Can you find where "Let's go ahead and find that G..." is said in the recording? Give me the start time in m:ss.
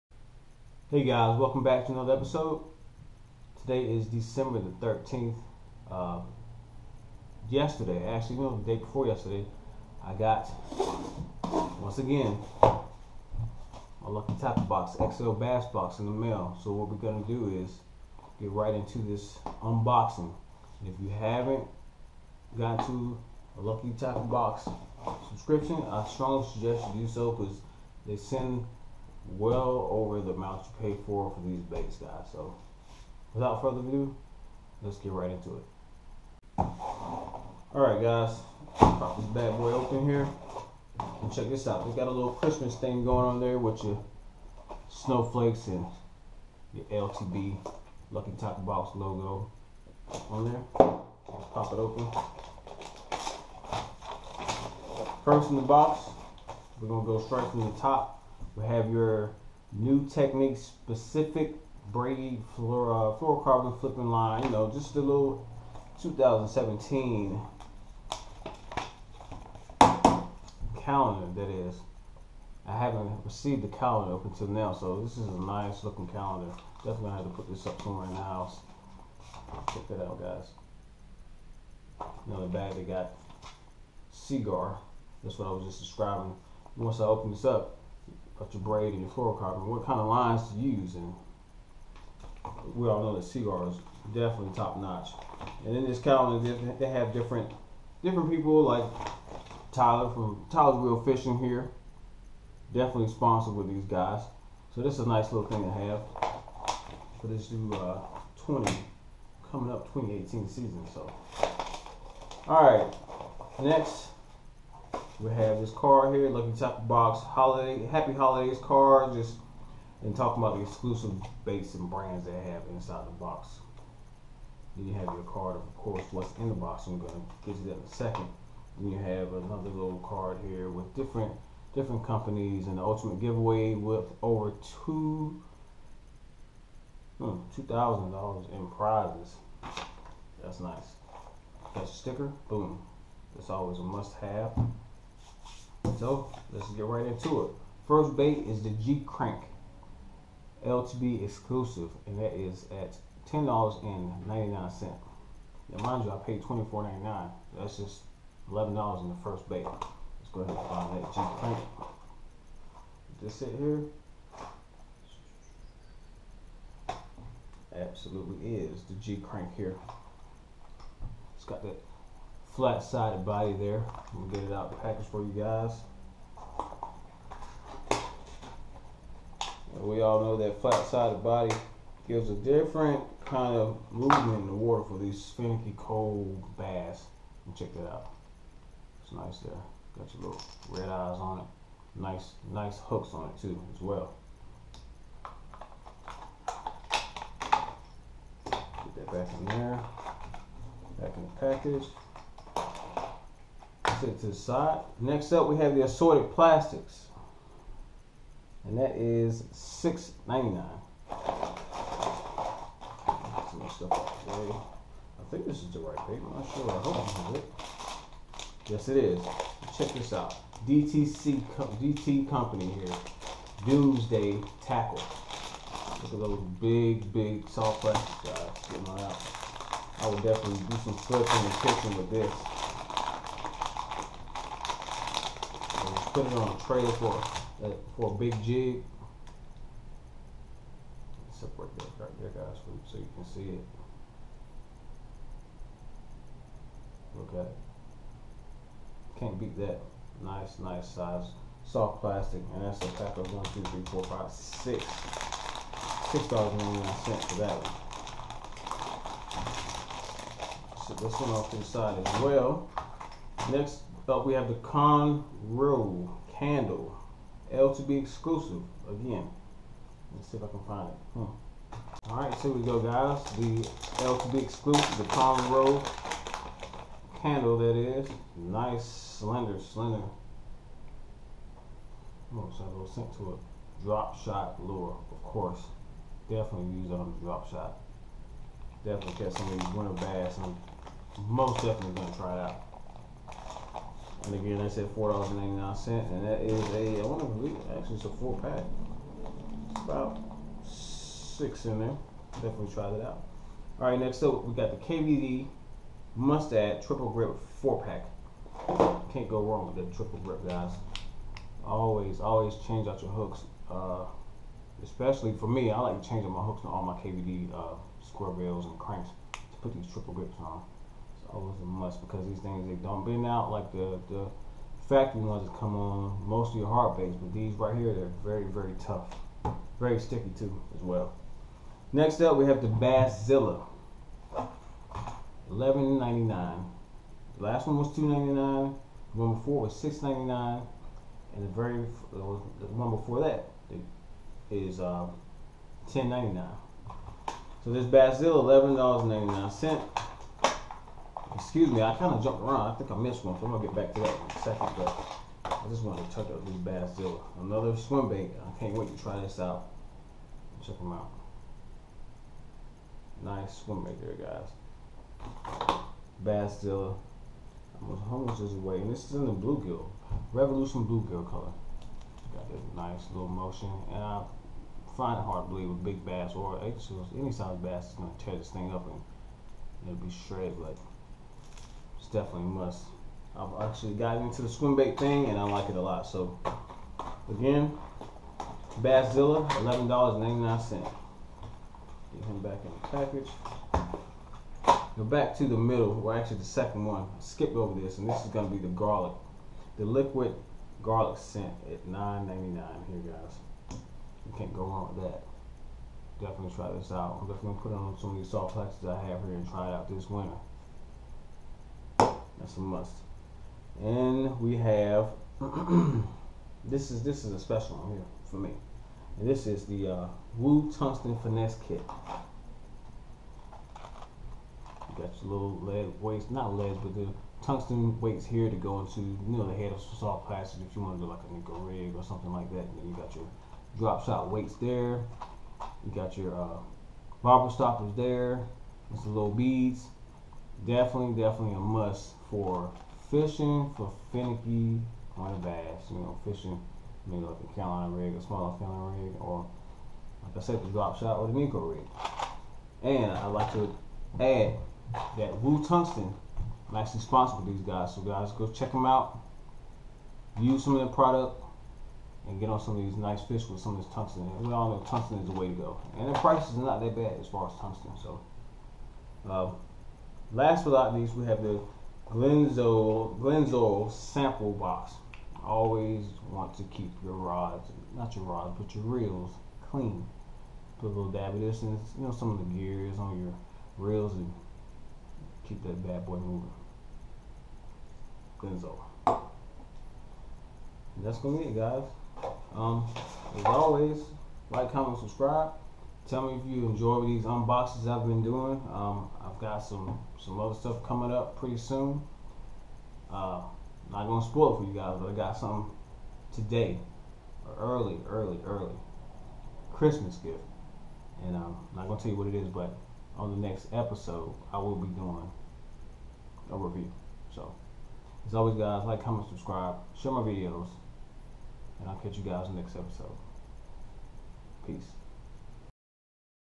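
2:39.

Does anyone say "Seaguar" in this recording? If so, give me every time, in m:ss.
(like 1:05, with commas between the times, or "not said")
1:24, 1:33.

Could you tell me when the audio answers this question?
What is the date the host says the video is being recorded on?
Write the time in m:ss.
0:04.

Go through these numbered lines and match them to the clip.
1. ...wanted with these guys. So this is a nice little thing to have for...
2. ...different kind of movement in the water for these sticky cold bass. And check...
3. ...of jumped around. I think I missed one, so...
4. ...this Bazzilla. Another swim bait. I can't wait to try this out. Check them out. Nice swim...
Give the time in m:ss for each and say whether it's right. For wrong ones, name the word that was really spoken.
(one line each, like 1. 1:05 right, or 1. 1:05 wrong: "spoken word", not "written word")
1. 1:43 wrong: "sponsored", not "wanted"
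2. 3:02 wrong: "finicky", not "sticky"
3. 5:52 right
4. 5:56 right.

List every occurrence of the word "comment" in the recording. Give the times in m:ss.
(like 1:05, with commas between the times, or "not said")
8:14, 8:39.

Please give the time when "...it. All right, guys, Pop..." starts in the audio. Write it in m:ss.
0:35.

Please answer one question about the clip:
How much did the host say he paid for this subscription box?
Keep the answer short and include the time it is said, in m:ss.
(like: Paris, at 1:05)
$24.99, at 2:36.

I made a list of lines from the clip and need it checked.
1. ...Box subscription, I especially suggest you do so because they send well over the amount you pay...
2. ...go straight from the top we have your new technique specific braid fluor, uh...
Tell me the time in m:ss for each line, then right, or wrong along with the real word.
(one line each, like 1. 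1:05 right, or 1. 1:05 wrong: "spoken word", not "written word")
1. 0:24 wrong: "strongly", not "especially"
2. 0:57 right.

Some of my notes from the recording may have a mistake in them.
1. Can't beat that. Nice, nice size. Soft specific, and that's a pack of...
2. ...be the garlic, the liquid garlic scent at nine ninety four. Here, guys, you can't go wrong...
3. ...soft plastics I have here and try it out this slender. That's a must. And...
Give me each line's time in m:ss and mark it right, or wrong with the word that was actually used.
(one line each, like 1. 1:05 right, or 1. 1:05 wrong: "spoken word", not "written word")
1. 4:09 wrong: "plastic", not "specific"
2. 6:38 wrong: "nine", not "four"
3. 6:48 wrong: "winter", not "slender".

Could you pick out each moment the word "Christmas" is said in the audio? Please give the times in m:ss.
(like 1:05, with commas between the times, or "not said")
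0:42, 8:29.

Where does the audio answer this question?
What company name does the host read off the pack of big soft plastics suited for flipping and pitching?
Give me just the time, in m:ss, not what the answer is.
3:43.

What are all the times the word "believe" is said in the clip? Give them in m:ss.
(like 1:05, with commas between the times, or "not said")
4:57, 6:15.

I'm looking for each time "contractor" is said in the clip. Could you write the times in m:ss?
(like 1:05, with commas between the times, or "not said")
not said.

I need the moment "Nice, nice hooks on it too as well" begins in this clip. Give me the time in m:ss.
3:11.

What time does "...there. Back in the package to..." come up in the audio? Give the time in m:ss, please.
3:19.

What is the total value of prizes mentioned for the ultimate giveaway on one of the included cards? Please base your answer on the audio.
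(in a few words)
over $2,000.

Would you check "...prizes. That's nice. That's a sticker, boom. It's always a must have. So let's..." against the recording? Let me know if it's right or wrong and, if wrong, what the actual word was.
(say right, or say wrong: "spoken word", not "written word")
right.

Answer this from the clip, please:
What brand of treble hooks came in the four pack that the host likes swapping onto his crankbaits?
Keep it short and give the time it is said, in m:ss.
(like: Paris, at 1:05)
KVD Mustad Triple Grip, at 5:04.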